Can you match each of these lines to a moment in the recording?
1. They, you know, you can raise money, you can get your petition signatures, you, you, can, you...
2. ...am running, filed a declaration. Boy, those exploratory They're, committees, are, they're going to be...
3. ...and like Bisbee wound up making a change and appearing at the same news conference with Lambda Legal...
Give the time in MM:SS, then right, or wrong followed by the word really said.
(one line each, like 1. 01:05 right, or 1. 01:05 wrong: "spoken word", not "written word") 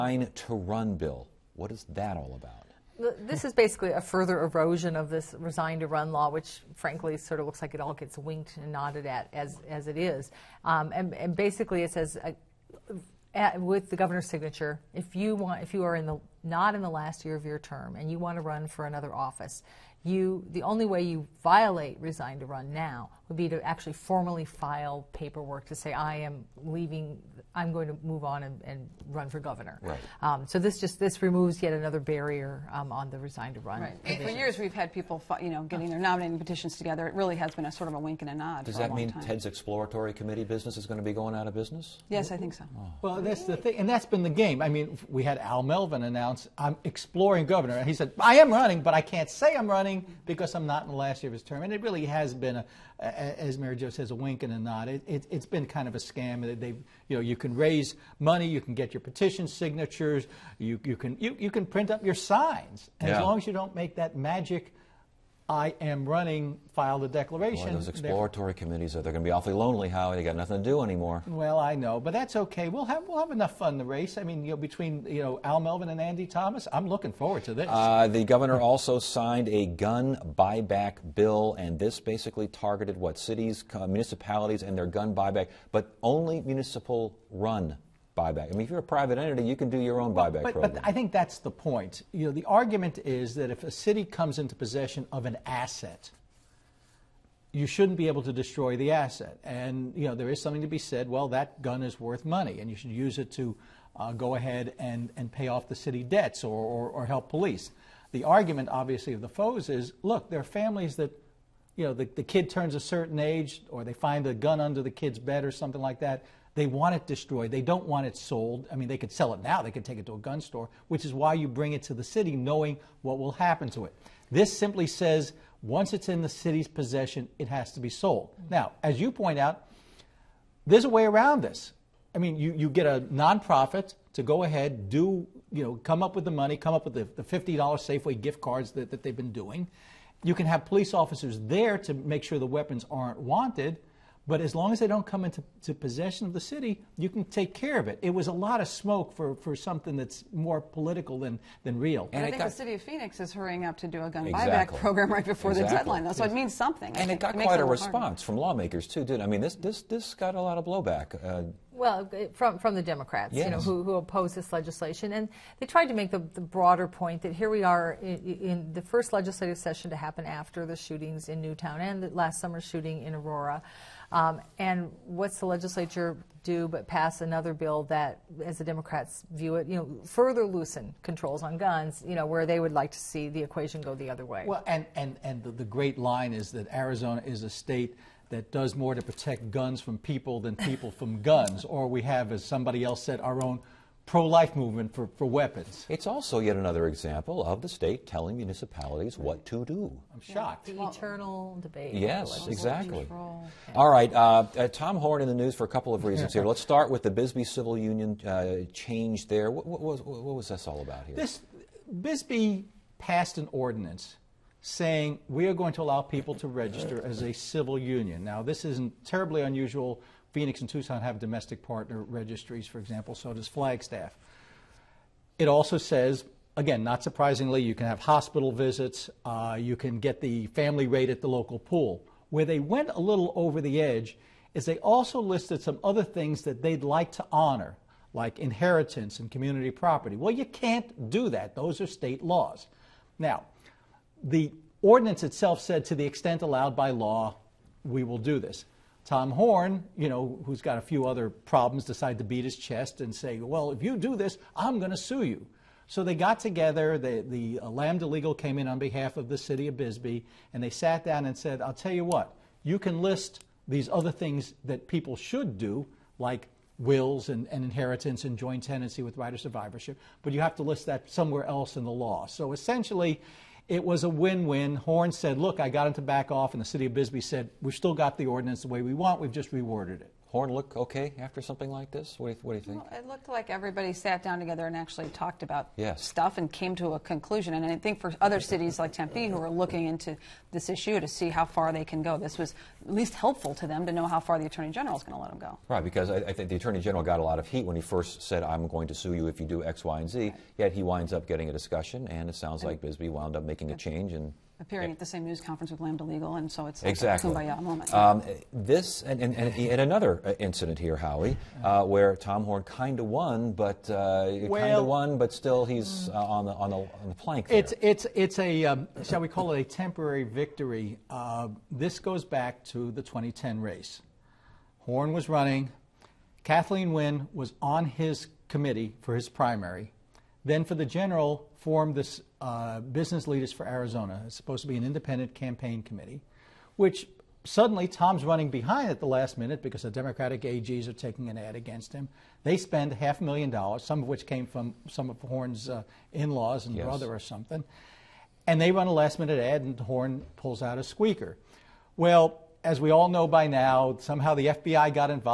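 1. 00:56 right
2. 01:05 right
3. 05:02 right.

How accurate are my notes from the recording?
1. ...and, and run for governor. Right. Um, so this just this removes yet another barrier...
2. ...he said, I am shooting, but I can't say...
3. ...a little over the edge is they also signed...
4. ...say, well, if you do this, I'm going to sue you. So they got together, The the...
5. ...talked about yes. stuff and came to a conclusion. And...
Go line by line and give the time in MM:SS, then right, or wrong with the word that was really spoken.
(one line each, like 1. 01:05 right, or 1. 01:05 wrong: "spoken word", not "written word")
1. 00:28 right
2. 00:47 wrong: "running", not "shooting"
3. 03:52 wrong: "listed", not "signed"
4. 04:13 right
5. 04:45 right.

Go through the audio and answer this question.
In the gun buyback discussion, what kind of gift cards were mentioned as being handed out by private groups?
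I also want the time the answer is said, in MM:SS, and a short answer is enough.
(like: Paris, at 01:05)
$50 Safeway gift cards, at 02:17.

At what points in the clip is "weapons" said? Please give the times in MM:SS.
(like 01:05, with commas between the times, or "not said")
02:22, 03:15.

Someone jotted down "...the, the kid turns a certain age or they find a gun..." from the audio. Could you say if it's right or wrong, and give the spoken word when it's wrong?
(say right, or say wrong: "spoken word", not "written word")
right.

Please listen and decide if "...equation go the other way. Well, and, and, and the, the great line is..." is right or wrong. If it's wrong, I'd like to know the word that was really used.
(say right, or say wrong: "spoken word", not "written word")
right.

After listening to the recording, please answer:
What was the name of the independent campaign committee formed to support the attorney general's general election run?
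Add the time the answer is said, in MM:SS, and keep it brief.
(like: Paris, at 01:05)
Business Leaders for Arizona, at 05:32.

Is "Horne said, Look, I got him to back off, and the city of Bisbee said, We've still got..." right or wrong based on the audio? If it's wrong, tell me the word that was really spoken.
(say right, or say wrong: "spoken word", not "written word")
right.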